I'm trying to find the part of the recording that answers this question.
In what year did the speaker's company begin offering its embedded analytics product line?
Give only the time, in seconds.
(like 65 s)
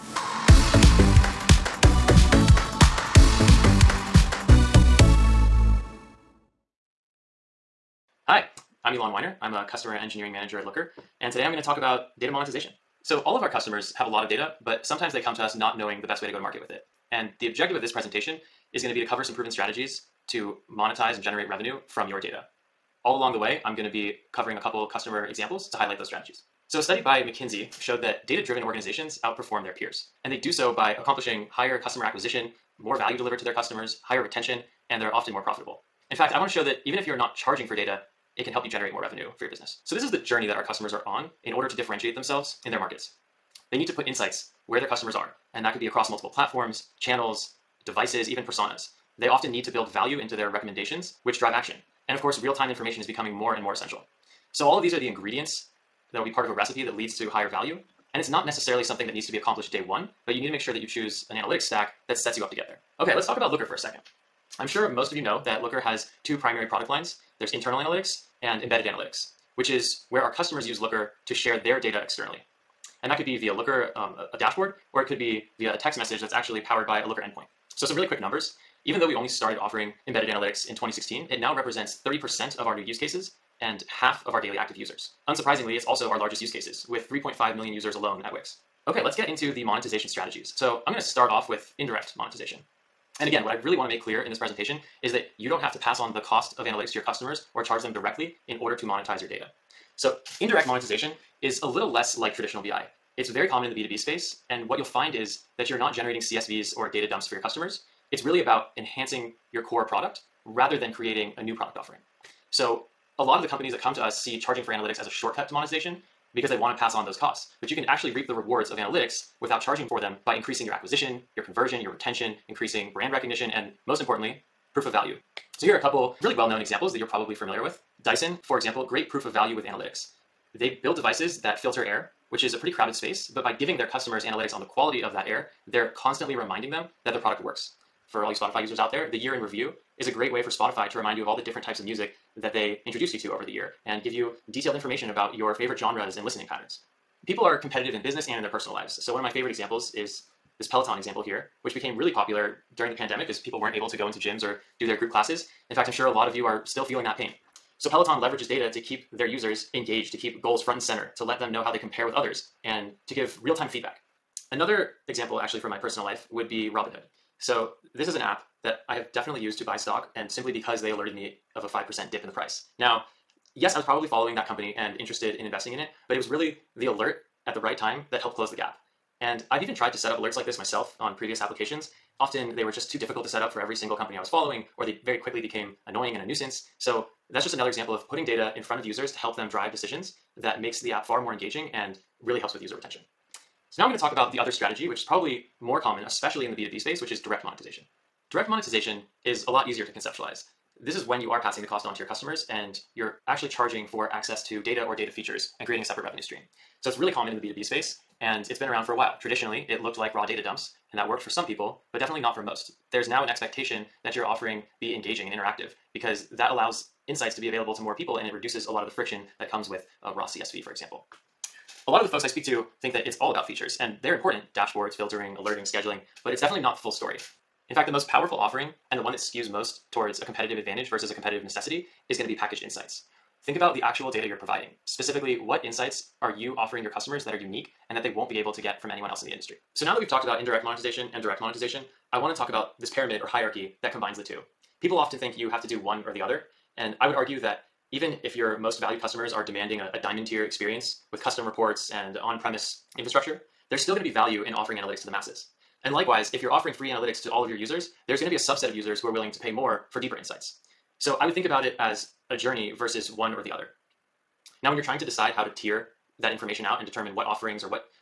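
80 s.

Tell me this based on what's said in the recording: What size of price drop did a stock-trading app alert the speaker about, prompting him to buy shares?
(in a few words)
5%.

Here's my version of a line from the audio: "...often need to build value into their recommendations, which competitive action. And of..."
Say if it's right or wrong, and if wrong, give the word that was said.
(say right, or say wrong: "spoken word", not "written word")
wrong: "drive", not "competitive".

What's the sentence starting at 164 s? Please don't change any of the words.
Another example, actually, from my personal life would be Robinhood.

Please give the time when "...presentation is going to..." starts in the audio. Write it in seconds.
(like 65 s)
17 s.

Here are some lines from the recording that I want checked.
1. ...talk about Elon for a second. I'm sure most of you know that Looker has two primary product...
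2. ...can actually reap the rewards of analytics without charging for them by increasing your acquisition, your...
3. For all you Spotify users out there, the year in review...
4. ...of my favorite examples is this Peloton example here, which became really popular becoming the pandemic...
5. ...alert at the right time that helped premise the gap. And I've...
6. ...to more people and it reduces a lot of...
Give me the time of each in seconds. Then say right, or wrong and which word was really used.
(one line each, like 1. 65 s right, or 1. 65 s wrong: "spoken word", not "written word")
1. 63 s wrong: "Looker", not "Elon"
2. 117 s right
3. 138 s right
4. 149 s wrong: "during", not "becoming"
5. 176 s wrong: "close", not "premise"
6. 217 s right.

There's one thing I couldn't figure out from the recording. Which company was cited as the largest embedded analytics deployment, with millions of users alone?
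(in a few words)
Wix.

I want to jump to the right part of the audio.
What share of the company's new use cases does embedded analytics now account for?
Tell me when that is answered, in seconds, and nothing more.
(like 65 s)
82 s.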